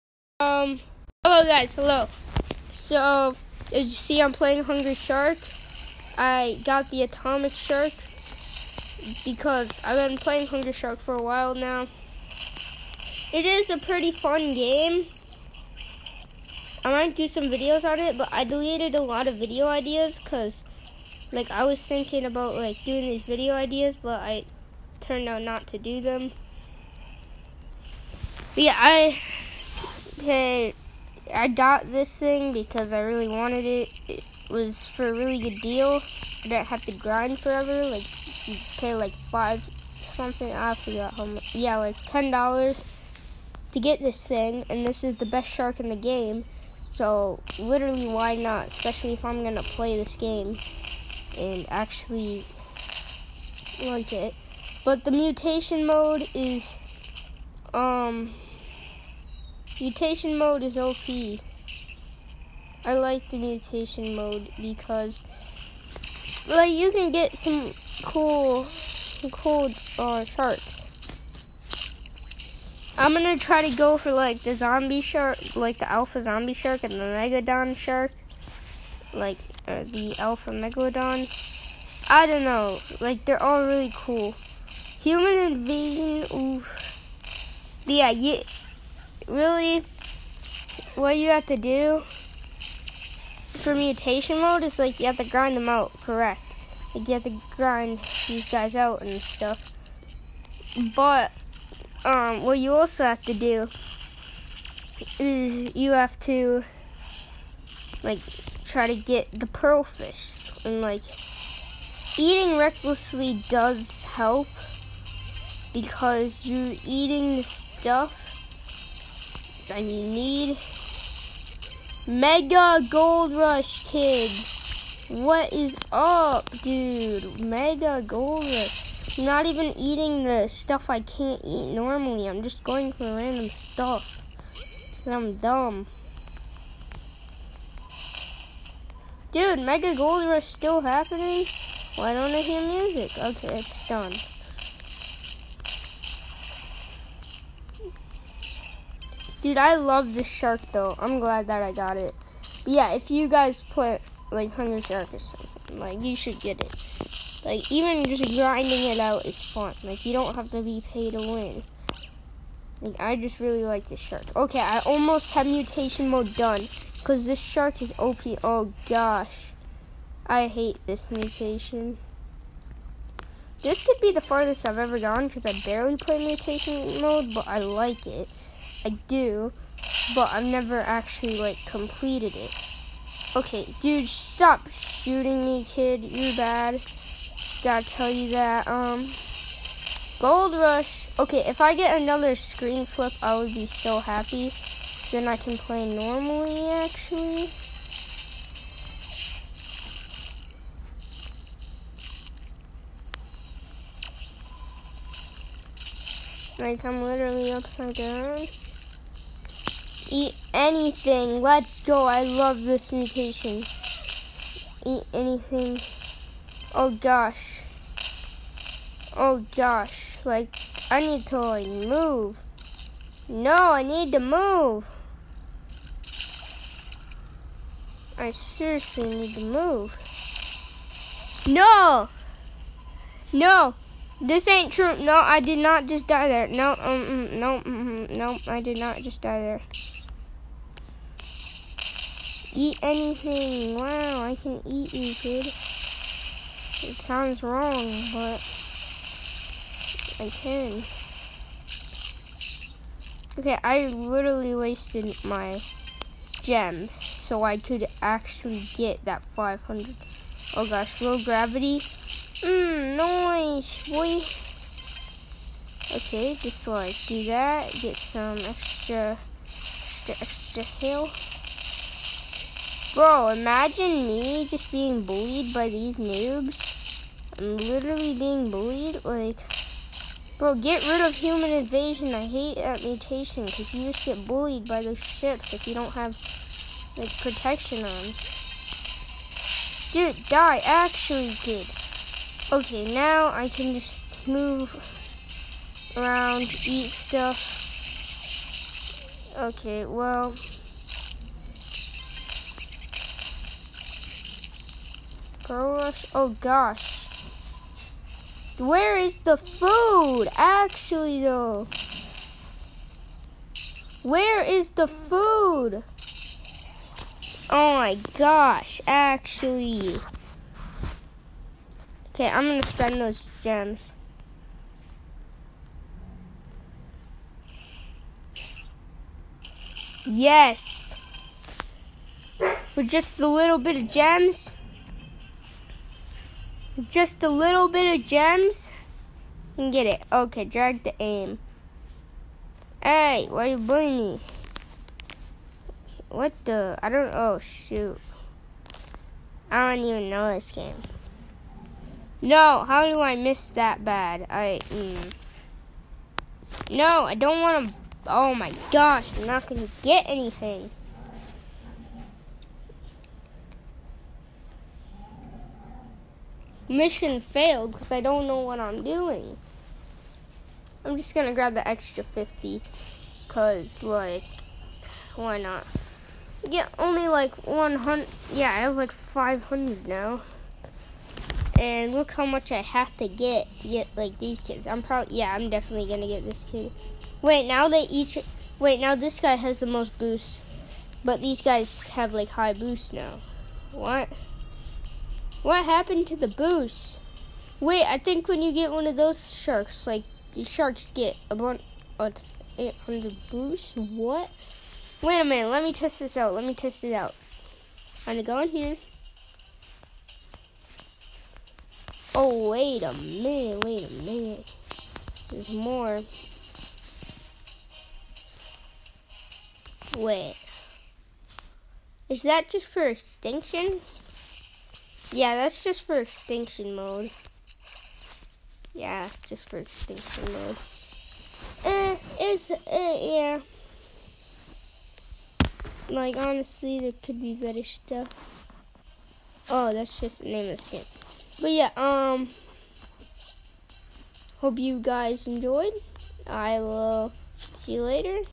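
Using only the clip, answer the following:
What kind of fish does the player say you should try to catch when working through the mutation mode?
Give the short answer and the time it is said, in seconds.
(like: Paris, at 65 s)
pearl fish, at 109 s.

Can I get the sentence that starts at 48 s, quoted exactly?
Especially if I'm gonna play this game and actually like it.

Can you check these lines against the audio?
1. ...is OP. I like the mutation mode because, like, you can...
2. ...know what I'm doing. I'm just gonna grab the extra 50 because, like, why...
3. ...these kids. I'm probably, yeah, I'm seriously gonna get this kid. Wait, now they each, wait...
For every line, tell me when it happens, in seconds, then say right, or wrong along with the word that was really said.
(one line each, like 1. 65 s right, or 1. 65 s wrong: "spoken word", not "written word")
1. 60 s right
2. 368 s right
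3. 384 s wrong: "definitely", not "seriously".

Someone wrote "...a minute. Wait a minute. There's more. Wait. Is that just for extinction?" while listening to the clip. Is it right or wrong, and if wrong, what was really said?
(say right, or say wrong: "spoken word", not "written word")
right.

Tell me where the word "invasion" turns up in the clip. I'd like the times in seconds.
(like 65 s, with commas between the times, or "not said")
85 s, 281 s.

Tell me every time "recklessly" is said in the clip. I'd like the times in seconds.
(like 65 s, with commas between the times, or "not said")
112 s.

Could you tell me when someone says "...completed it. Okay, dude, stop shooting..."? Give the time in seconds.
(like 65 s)
181 s.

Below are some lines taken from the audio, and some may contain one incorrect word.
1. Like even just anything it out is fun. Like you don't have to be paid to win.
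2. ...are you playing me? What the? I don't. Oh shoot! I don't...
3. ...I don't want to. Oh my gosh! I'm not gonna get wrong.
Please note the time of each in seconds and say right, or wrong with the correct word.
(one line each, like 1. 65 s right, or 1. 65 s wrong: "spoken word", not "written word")
1. 157 s wrong: "grinding", not "anything"
2. 343 s wrong: "bullying", not "playing"
3. 357 s wrong: "anything", not "wrong".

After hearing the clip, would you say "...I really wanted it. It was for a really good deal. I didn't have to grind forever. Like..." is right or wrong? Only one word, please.
right.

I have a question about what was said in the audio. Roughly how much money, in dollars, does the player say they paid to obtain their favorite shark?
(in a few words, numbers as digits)
10 dollars.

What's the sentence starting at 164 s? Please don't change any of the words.
Okay, I almost have mutation mode done because this shark is OP.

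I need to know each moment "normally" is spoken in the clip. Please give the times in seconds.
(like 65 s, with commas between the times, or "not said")
131 s, 195 s.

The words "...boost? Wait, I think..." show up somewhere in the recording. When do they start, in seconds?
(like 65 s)
396 s.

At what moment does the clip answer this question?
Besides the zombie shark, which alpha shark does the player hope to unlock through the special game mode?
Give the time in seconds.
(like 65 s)
79 s.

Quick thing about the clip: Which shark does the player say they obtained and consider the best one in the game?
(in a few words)
Atomic Shark.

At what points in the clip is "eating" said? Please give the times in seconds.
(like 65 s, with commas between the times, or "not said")
112 s, 116 s, 129 s.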